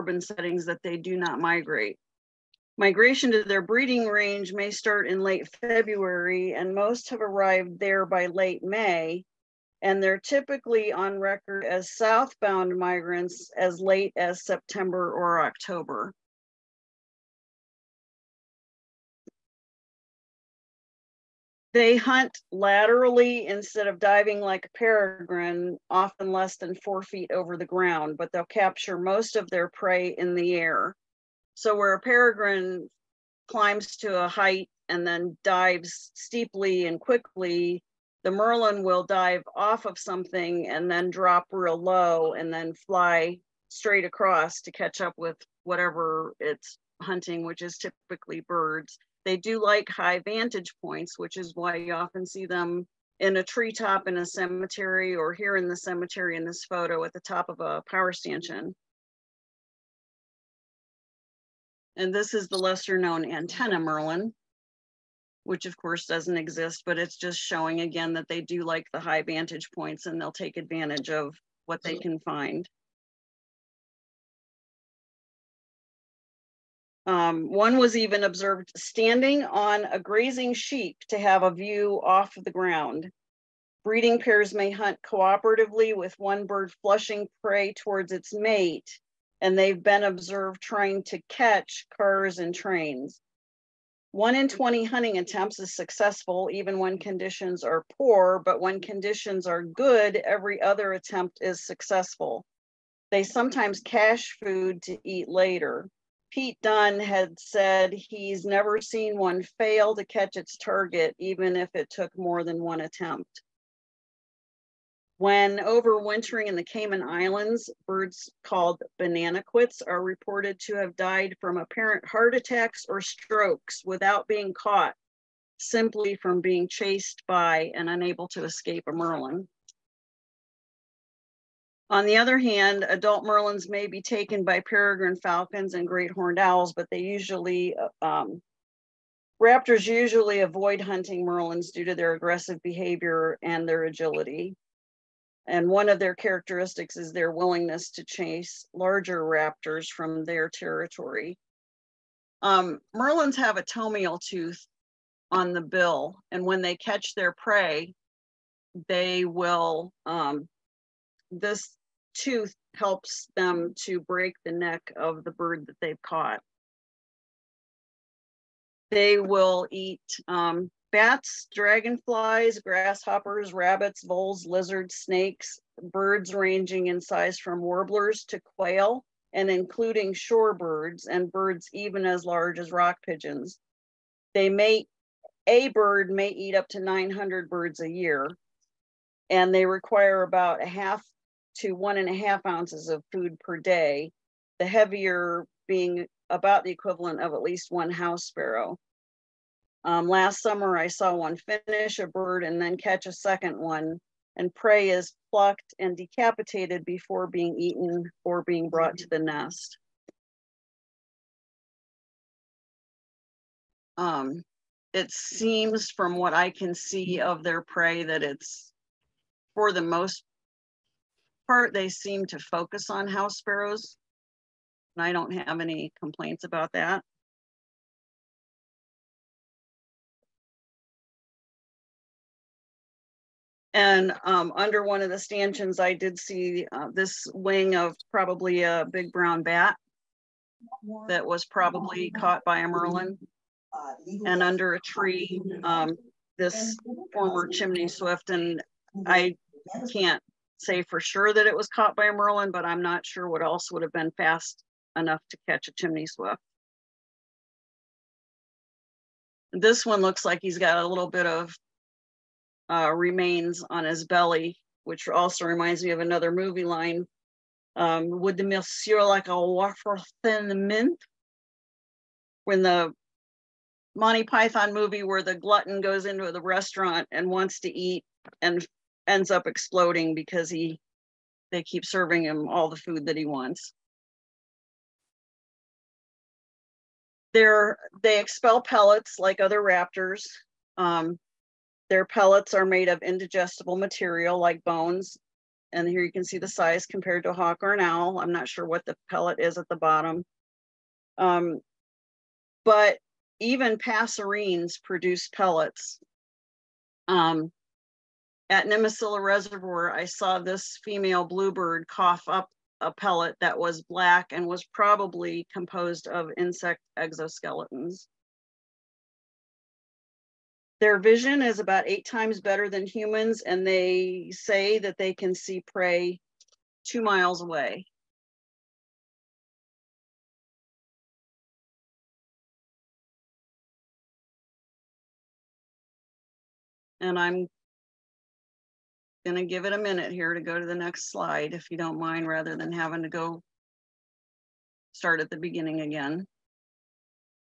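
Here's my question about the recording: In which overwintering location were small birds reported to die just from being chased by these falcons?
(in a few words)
Cayman Islands.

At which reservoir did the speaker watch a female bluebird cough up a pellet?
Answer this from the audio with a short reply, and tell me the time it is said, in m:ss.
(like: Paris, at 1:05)
Nimisila Reservoir, at 5:08.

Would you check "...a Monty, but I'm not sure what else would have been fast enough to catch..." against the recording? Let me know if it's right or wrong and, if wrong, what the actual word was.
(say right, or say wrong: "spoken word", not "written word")
wrong: "Merlin", not "Monty".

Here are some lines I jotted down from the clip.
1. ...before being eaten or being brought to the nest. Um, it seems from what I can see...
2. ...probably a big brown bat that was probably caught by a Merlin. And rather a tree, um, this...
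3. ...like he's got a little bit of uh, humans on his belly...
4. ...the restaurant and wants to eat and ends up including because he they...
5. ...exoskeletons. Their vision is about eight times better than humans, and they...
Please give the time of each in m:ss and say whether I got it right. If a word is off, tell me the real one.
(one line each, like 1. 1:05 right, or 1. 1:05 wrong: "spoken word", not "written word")
1. 3:26 right
2. 3:58 wrong: "under", not "rather"
3. 4:20 wrong: "remains", not "humans"
4. 4:36 wrong: "exploding", not "including"
5. 5:16 right.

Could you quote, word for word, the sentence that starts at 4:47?
They're, they expel pellets like other raptors.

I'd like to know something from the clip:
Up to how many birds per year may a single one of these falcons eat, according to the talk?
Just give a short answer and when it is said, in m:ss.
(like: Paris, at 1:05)
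900, at 3:06.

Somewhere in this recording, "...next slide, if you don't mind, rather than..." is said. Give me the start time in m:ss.
5:40.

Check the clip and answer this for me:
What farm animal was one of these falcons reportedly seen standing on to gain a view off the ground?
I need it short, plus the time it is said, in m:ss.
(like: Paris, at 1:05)
a grazing sheep, at 1:19.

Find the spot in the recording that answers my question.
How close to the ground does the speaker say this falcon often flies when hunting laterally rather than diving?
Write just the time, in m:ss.
0:26.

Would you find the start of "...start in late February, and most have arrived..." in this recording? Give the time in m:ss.
0:04.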